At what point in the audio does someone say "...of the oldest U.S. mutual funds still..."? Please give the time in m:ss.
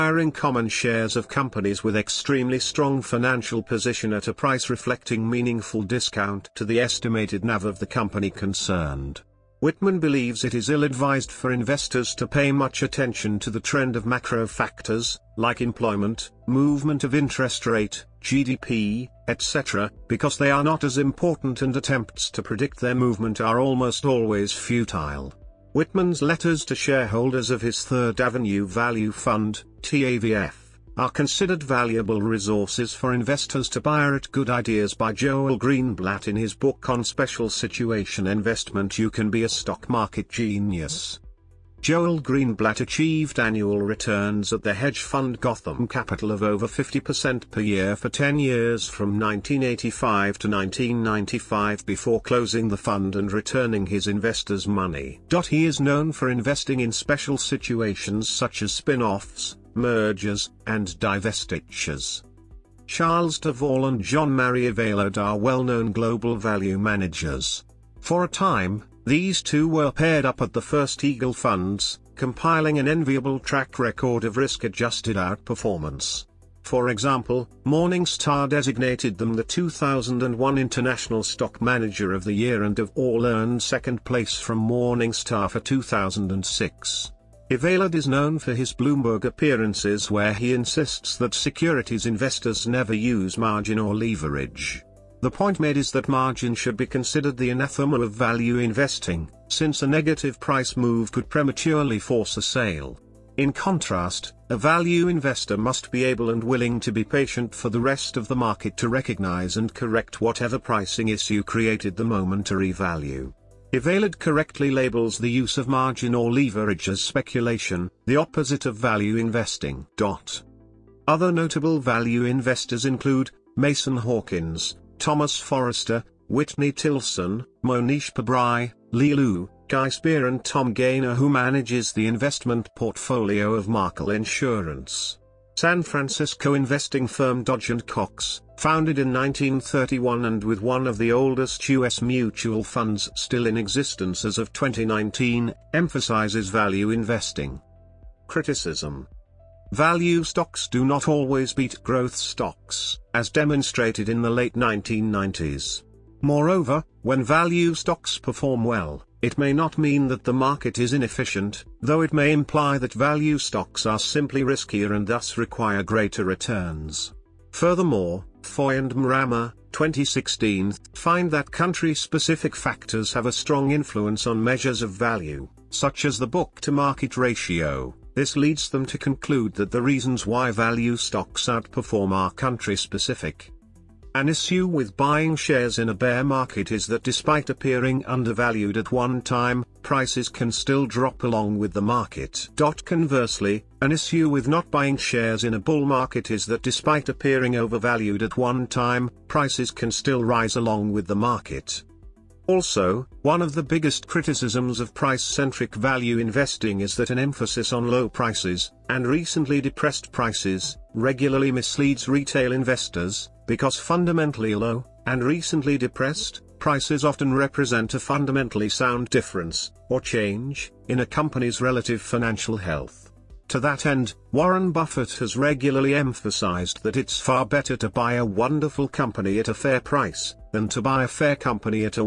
2:20.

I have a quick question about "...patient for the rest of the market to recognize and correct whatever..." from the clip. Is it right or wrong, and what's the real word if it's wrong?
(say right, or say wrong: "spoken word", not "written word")
right.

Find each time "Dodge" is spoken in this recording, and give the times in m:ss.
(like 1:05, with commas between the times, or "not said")
2:17.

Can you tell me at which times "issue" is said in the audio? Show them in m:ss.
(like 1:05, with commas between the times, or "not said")
1:51, 3:04, 3:13.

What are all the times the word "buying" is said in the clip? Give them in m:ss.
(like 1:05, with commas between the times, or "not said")
3:04, 3:14.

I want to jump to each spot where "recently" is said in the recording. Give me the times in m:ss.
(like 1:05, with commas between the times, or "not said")
3:29, 3:35.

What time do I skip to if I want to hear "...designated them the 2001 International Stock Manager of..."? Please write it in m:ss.
1:18.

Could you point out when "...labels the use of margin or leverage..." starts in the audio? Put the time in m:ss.
1:54.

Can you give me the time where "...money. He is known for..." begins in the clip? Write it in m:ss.
0:54.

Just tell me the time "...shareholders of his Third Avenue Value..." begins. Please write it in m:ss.
0:26.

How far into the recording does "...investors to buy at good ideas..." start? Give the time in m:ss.
0:33.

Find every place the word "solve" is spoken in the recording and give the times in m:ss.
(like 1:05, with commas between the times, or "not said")
not said.